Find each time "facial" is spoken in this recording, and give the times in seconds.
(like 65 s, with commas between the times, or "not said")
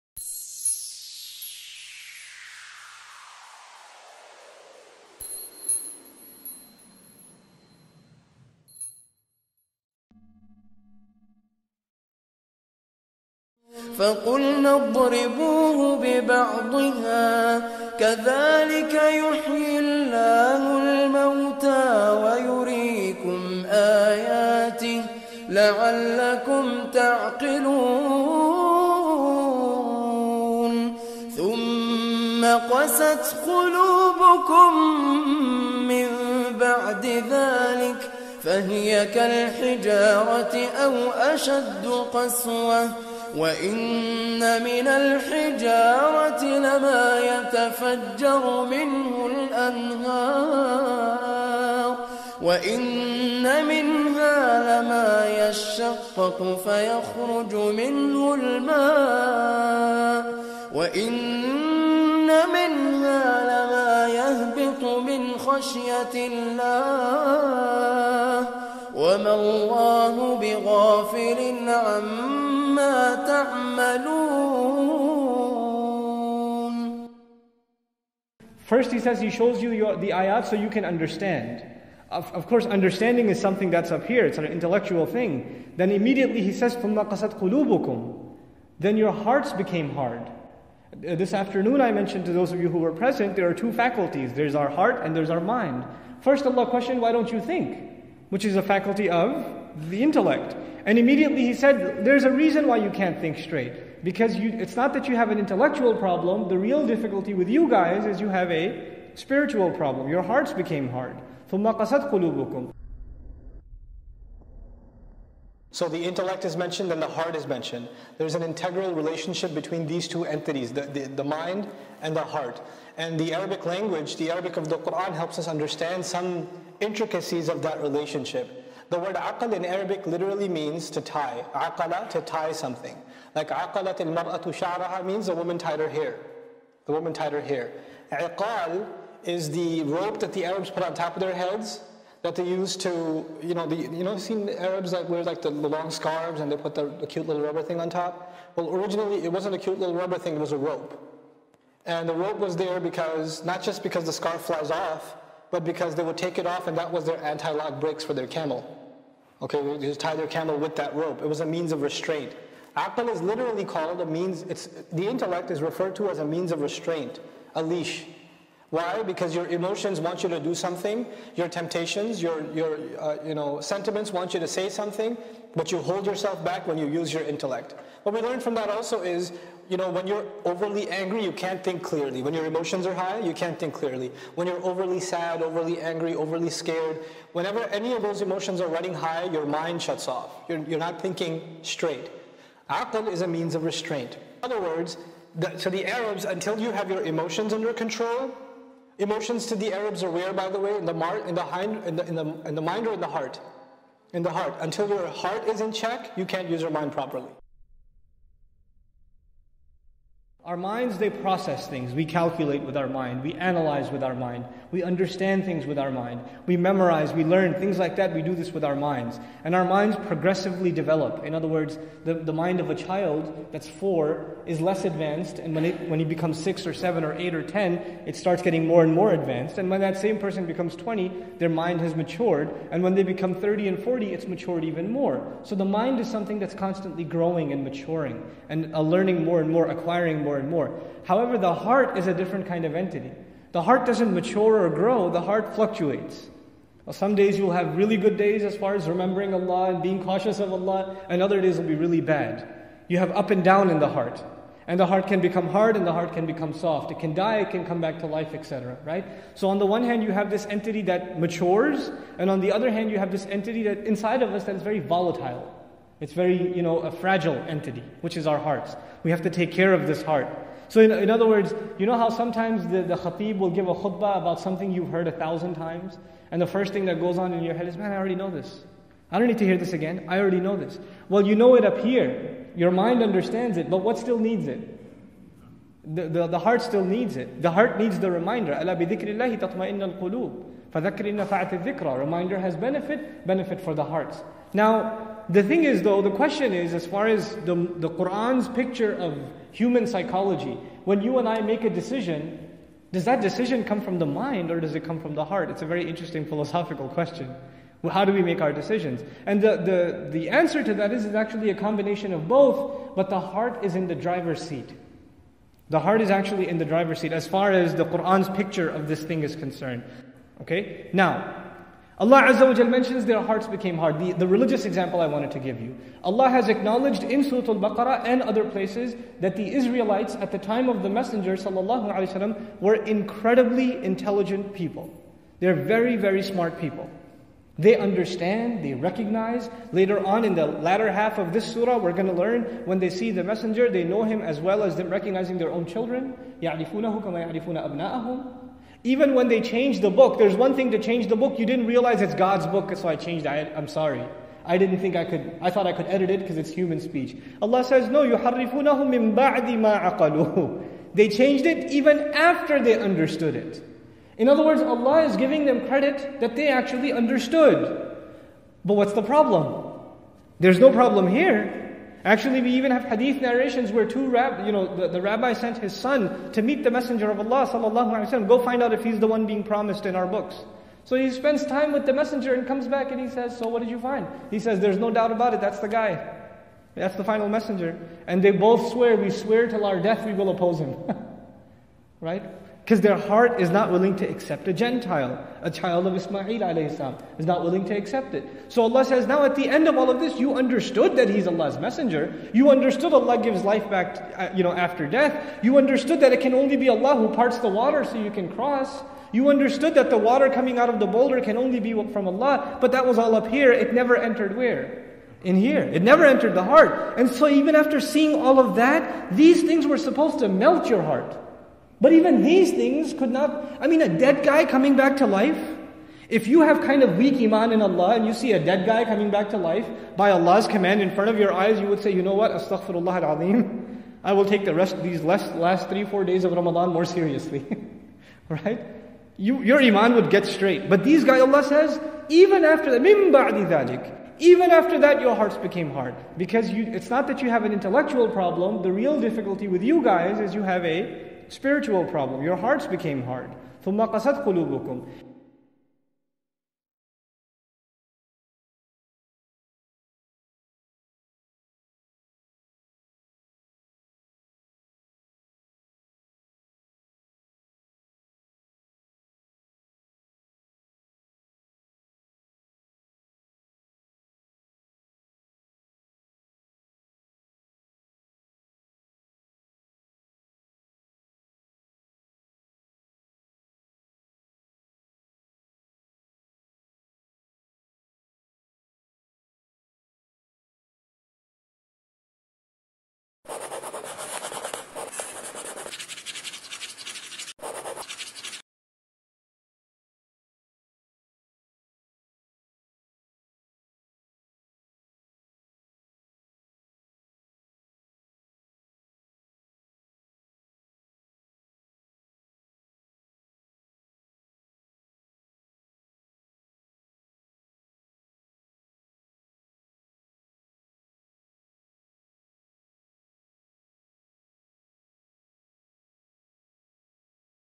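not said.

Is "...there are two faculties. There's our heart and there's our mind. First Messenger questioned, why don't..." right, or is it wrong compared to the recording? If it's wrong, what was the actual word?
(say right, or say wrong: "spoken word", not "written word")
wrong: "Allah", not "Messenger".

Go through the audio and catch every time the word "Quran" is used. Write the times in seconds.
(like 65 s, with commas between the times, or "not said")
124 s, 297 s, 317 s.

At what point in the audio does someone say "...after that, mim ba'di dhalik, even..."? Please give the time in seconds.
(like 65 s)
442 s.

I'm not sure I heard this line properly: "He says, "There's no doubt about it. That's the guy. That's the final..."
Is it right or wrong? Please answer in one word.
right.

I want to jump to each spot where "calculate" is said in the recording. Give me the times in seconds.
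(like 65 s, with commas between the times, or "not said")
212 s.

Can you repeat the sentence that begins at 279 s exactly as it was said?
I don't need to hear this again.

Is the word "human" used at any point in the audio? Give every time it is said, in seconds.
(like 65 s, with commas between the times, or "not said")
299 s, 356 s.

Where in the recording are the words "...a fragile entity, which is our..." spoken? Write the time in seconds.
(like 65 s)
266 s.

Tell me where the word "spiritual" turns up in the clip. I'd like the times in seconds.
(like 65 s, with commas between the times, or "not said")
109 s, 451 s.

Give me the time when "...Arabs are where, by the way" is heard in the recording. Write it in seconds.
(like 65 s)
199 s.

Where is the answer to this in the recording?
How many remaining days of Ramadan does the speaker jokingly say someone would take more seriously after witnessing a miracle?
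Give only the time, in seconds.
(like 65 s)
435 s.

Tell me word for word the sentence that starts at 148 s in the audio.
Well, originally it wasn't a cute little rubber thing, it was a rope.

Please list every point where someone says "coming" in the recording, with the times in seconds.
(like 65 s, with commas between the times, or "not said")
410 s, 424 s, 428 s.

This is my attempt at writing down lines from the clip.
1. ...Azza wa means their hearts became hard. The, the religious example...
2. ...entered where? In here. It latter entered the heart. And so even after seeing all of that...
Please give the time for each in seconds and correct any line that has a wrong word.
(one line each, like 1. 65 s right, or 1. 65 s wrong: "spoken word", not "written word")
1. 322 s wrong: "mentions", not "means"
2. 413 s wrong: "never", not "latter".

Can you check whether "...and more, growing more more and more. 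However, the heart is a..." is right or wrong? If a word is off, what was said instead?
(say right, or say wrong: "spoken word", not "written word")
wrong: "acquiring", not "growing".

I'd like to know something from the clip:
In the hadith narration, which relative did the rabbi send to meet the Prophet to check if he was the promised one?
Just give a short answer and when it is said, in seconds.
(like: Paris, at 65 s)
His son, at 374 s.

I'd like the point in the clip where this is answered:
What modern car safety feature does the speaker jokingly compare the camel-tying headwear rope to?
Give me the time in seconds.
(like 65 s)
157 s.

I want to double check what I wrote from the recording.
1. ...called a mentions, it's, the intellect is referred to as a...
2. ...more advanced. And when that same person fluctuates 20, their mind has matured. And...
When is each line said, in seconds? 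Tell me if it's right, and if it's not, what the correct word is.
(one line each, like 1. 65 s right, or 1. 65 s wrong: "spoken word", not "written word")
1. 163 s wrong: "means", not "mentions"
2. 228 s wrong: "becomes", not "fluctuates".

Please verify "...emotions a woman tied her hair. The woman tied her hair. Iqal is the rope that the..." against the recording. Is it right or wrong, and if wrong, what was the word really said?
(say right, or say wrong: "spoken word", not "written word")
wrong: "means", not "emotions".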